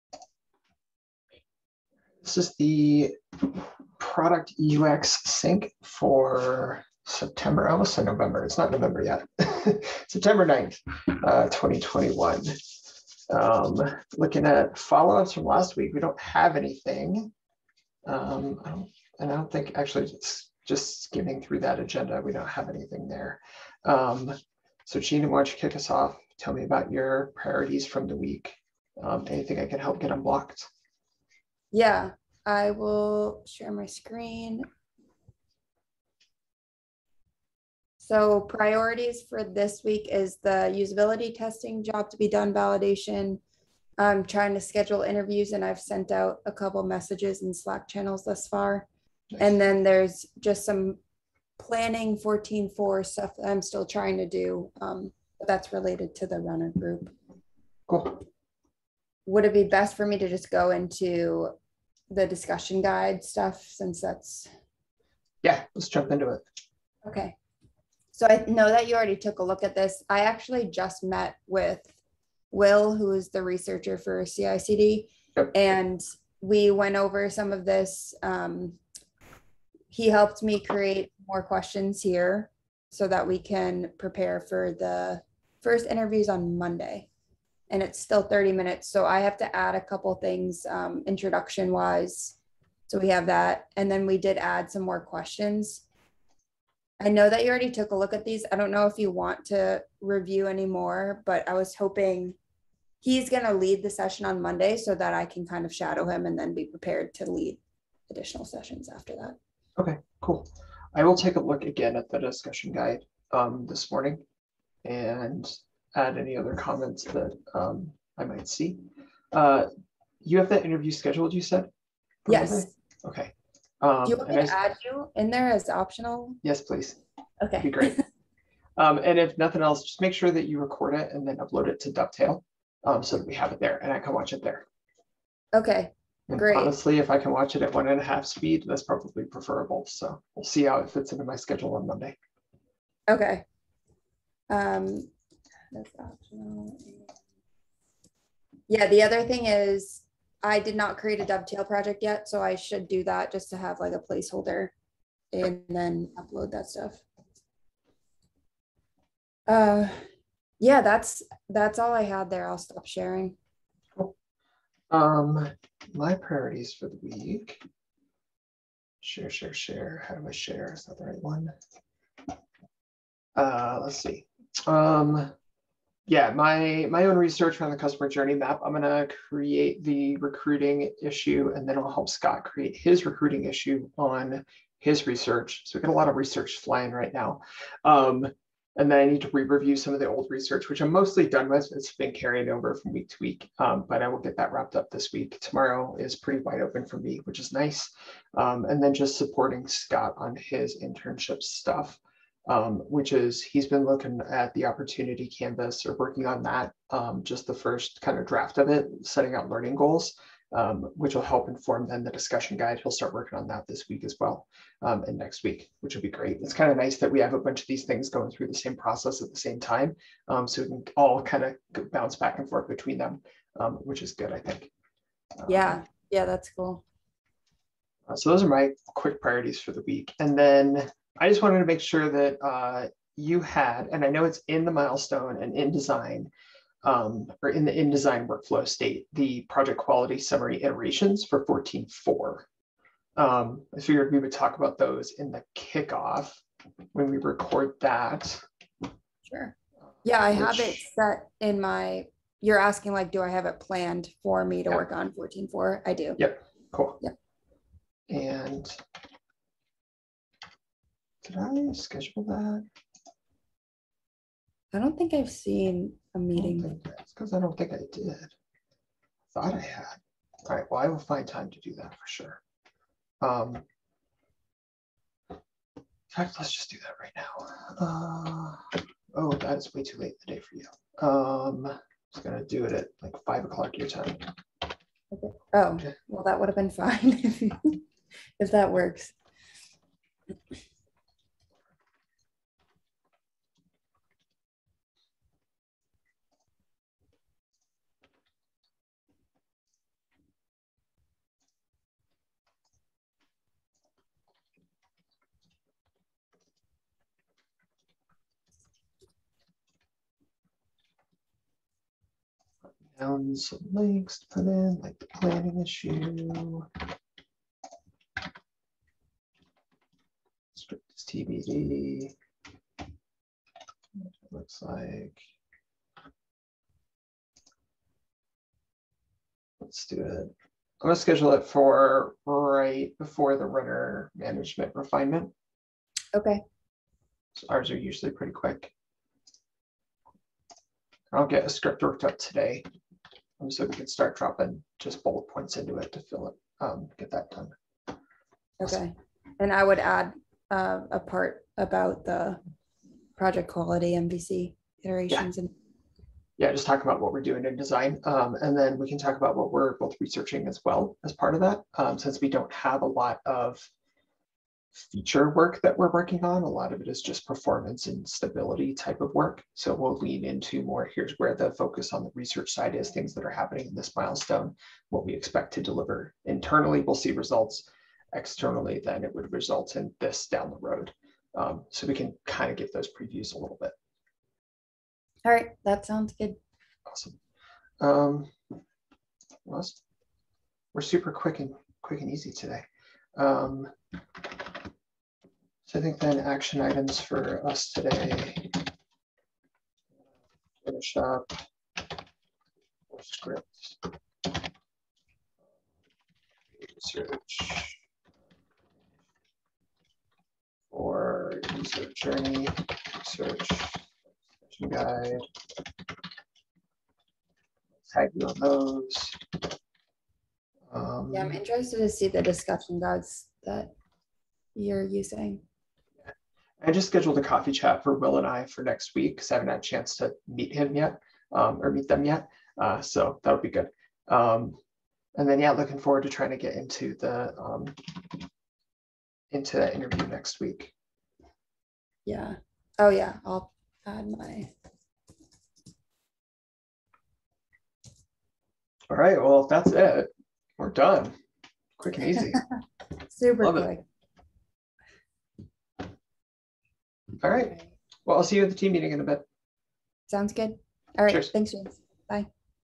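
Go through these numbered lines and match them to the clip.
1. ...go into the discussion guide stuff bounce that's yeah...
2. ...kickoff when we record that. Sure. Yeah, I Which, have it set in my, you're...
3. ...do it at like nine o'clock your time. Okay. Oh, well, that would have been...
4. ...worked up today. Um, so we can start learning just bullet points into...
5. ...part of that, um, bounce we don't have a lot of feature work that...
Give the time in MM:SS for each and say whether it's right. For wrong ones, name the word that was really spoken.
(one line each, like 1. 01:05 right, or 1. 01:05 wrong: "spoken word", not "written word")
1. 01:00 wrong: "since", not "bounce"
2. 04:05 right
3. 04:42 wrong: "five", not "nine"
4. 05:41 wrong: "dropping", not "learning"
5. 06:01 wrong: "since", not "bounce".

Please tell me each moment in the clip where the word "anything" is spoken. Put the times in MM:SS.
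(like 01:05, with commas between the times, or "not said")
00:16, 00:22, 00:29.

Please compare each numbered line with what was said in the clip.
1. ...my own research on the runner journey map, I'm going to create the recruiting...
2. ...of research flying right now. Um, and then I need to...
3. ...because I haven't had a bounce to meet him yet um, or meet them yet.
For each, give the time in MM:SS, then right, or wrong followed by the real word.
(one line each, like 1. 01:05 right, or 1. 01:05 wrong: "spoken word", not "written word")
1. 02:56 wrong: "customer", not "runner"
2. 03:06 right
3. 07:09 wrong: "chance", not "bounce".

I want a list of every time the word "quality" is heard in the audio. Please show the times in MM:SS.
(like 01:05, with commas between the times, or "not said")
03:59, 05:53.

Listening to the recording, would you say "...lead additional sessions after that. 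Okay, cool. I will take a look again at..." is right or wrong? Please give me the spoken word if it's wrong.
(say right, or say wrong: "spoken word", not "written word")
right.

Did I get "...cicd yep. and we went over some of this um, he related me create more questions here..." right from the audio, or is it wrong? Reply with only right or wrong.
wrong.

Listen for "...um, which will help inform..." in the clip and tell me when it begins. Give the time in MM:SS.
03:30.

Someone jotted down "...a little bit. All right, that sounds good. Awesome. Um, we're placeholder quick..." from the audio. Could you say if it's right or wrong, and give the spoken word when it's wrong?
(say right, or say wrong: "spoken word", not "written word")
wrong: "super", not "placeholder".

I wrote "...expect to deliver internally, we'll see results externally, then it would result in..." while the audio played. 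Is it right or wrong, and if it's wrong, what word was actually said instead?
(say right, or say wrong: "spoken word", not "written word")
right.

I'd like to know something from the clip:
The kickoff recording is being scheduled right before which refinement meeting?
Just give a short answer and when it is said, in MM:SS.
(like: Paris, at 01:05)
runner management refinement, at 05:33.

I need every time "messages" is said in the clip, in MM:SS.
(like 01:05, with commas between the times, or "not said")
00:46.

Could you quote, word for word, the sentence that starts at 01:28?
So I have to add a couple things um, introduction wise.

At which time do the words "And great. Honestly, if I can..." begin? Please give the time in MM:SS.
02:16.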